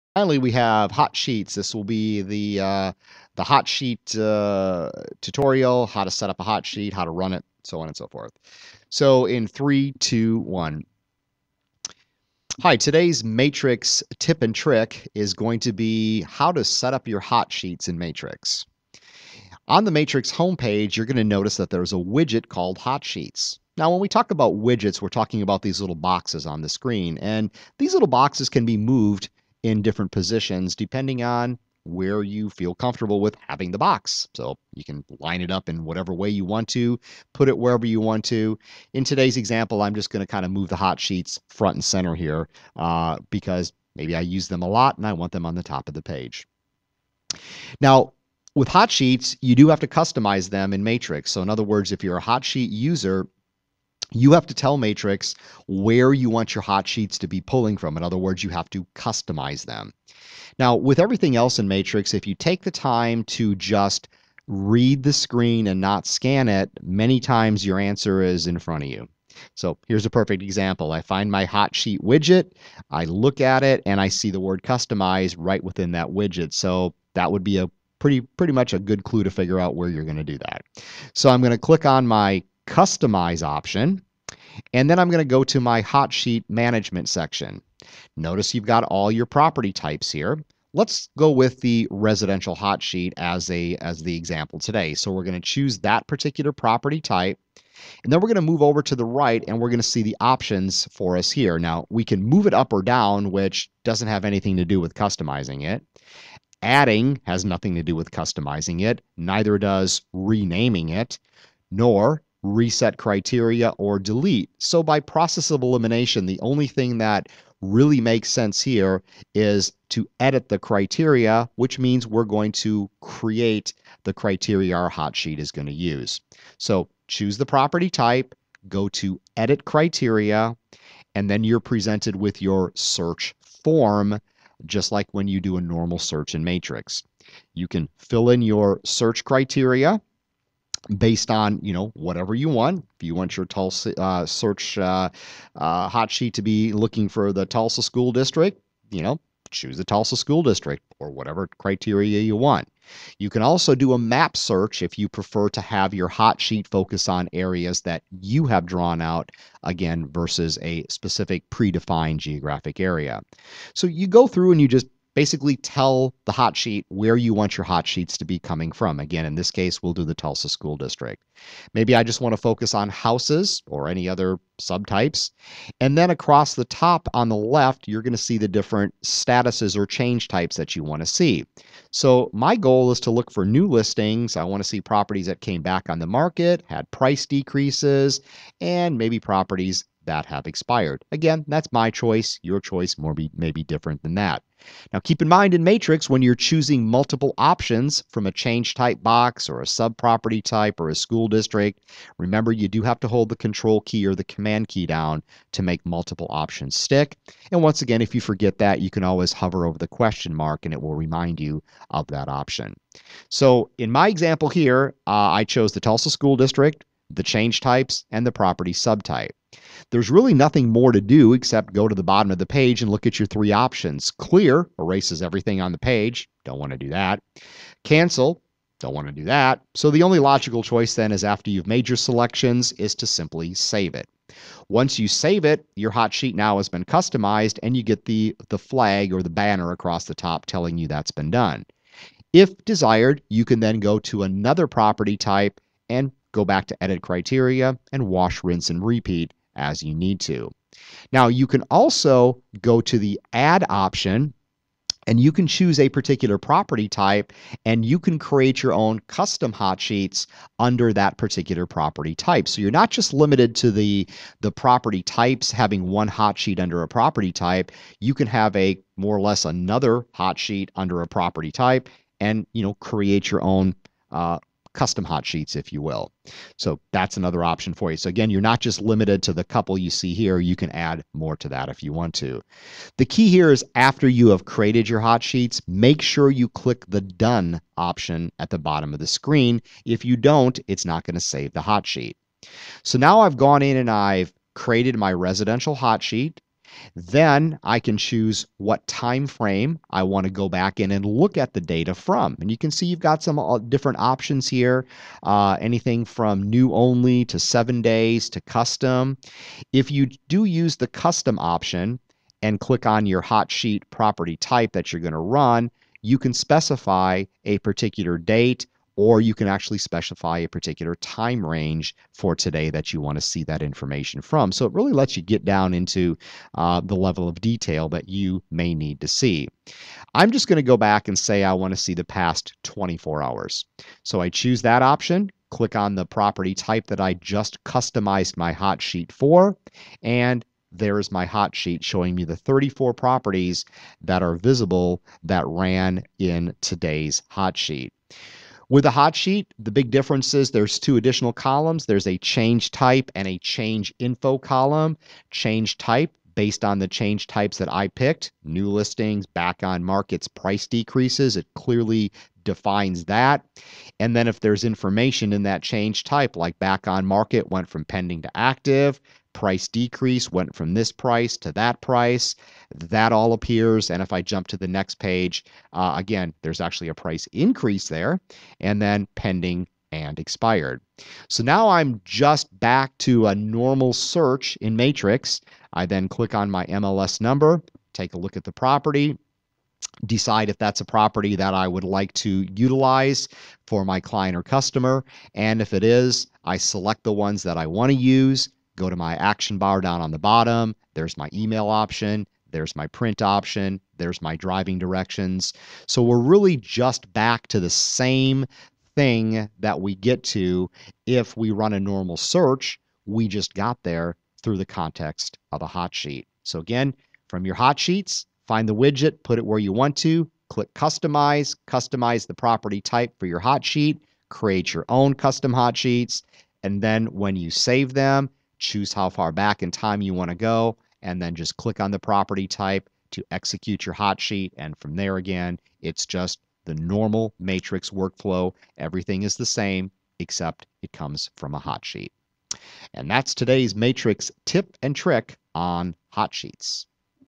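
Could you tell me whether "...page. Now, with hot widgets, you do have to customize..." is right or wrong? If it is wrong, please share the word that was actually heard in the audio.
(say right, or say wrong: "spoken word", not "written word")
wrong: "sheets", not "widgets".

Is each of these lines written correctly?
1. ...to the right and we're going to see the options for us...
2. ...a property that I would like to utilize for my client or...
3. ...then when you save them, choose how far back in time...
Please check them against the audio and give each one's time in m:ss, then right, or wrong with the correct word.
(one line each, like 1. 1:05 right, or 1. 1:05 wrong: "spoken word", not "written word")
1. 1:38 right
2. 6:30 right
3. 7:06 right.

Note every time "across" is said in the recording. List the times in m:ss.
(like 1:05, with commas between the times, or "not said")
2:56, 3:59.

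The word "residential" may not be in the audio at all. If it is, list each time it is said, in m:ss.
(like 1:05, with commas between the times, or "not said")
1:31, 4:55.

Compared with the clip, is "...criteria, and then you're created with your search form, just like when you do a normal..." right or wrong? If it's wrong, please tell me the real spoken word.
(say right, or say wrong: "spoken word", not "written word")
wrong: "presented", not "created".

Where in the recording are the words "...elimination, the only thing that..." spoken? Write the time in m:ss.
1:55.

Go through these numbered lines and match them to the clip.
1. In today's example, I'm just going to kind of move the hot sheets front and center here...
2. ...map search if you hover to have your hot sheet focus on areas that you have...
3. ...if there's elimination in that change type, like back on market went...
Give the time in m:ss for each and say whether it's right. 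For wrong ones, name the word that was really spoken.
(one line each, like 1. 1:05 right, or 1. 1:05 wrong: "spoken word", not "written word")
1. 0:38 right
2. 2:33 wrong: "prefer", not "hover"
3. 6:04 wrong: "information", not "elimination".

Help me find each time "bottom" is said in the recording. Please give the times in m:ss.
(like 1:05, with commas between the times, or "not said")
3:42, 4:48, 6:40.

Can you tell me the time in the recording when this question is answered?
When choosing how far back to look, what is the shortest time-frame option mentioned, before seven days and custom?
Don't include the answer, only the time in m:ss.
5:06.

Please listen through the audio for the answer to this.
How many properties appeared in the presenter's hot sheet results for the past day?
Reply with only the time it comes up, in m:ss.
5:42.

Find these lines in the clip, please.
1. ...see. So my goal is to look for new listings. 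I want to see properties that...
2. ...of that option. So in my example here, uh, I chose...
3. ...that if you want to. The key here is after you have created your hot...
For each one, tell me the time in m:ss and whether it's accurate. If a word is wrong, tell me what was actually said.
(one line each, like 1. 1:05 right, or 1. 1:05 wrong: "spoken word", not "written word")
1. 3:01 right
2. 3:31 right
3. 4:41 right.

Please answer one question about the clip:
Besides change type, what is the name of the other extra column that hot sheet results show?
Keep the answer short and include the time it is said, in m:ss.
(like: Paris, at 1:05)
Change info, at 5:53.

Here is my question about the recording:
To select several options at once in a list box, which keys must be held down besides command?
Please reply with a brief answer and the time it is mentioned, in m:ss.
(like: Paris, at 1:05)
Control key, at 3:23.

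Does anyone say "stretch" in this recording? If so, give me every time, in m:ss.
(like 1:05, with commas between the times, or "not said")
not said.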